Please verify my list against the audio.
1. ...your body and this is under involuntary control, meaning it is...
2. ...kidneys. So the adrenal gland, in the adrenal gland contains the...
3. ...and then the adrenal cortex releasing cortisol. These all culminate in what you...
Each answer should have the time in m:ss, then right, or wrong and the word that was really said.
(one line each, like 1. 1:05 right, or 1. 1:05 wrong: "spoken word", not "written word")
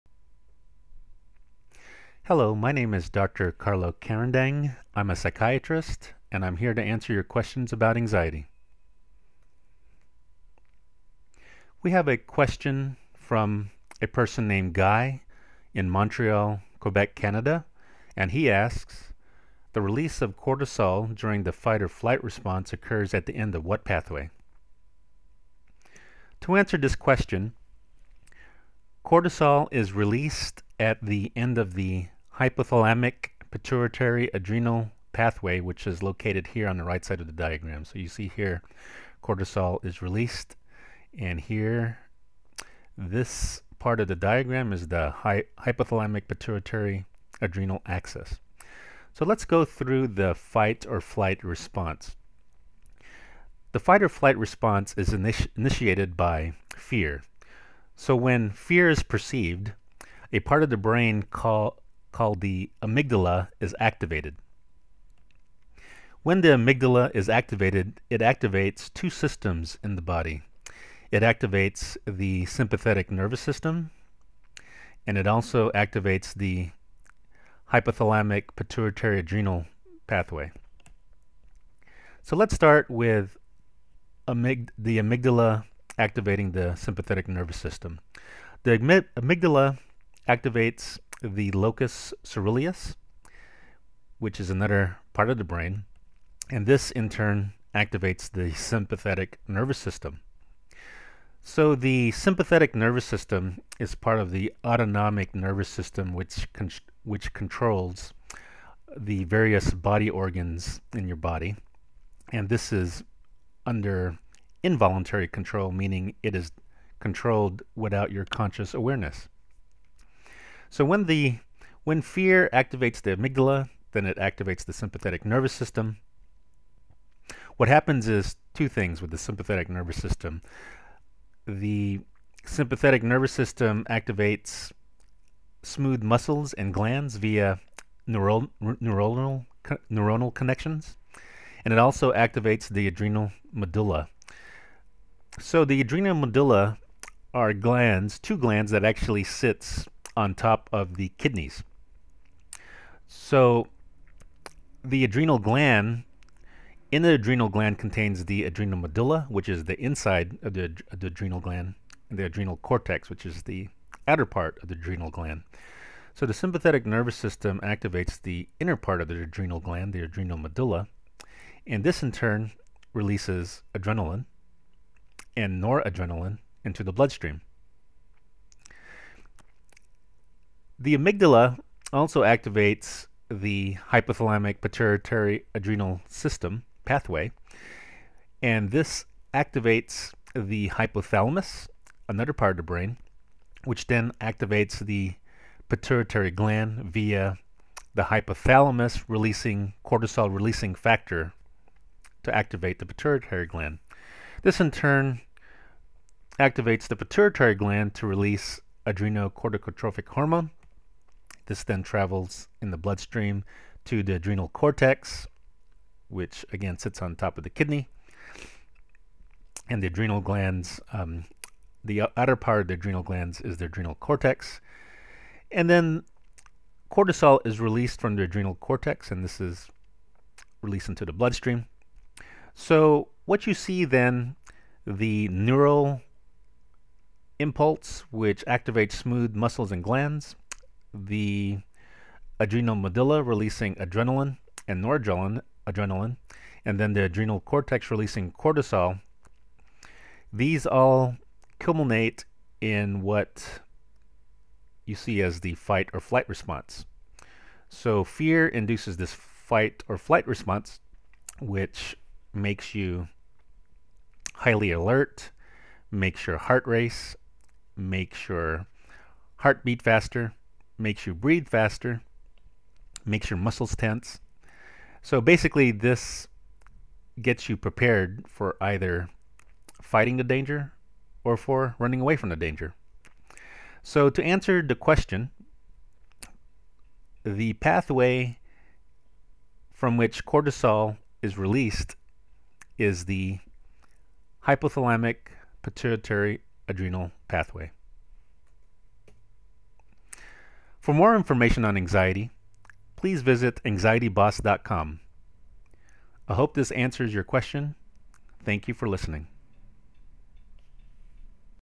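1. 1:51 right
2. 2:31 right
3. 4:06 right.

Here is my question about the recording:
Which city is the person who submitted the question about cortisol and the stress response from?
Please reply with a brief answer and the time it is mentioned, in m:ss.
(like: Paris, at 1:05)
Montreal, at 0:15.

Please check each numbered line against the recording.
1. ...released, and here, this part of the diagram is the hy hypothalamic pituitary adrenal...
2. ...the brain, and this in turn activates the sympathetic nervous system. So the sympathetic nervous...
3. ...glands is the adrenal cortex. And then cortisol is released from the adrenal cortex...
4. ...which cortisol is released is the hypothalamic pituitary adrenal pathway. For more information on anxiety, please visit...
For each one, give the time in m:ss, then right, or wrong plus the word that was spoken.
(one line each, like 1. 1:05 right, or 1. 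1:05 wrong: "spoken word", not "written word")
1. 0:40 right
2. 1:35 right
3. 3:43 right
4. 4:49 right.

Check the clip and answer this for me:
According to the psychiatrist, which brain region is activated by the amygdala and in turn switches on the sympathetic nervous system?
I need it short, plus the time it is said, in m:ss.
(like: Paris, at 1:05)
locus ceruleus, at 1:31.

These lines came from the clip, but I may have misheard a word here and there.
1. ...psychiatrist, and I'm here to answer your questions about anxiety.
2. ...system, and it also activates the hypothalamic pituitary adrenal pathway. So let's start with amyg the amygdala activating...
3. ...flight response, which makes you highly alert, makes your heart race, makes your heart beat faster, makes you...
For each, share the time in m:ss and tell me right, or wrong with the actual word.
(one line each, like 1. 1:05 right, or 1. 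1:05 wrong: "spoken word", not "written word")
1. 0:05 right
2. 1:13 right
3. 4:19 right.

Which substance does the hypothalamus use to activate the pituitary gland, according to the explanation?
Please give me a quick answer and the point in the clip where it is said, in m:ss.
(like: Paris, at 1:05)
cortisol releasing factor, at 3:19.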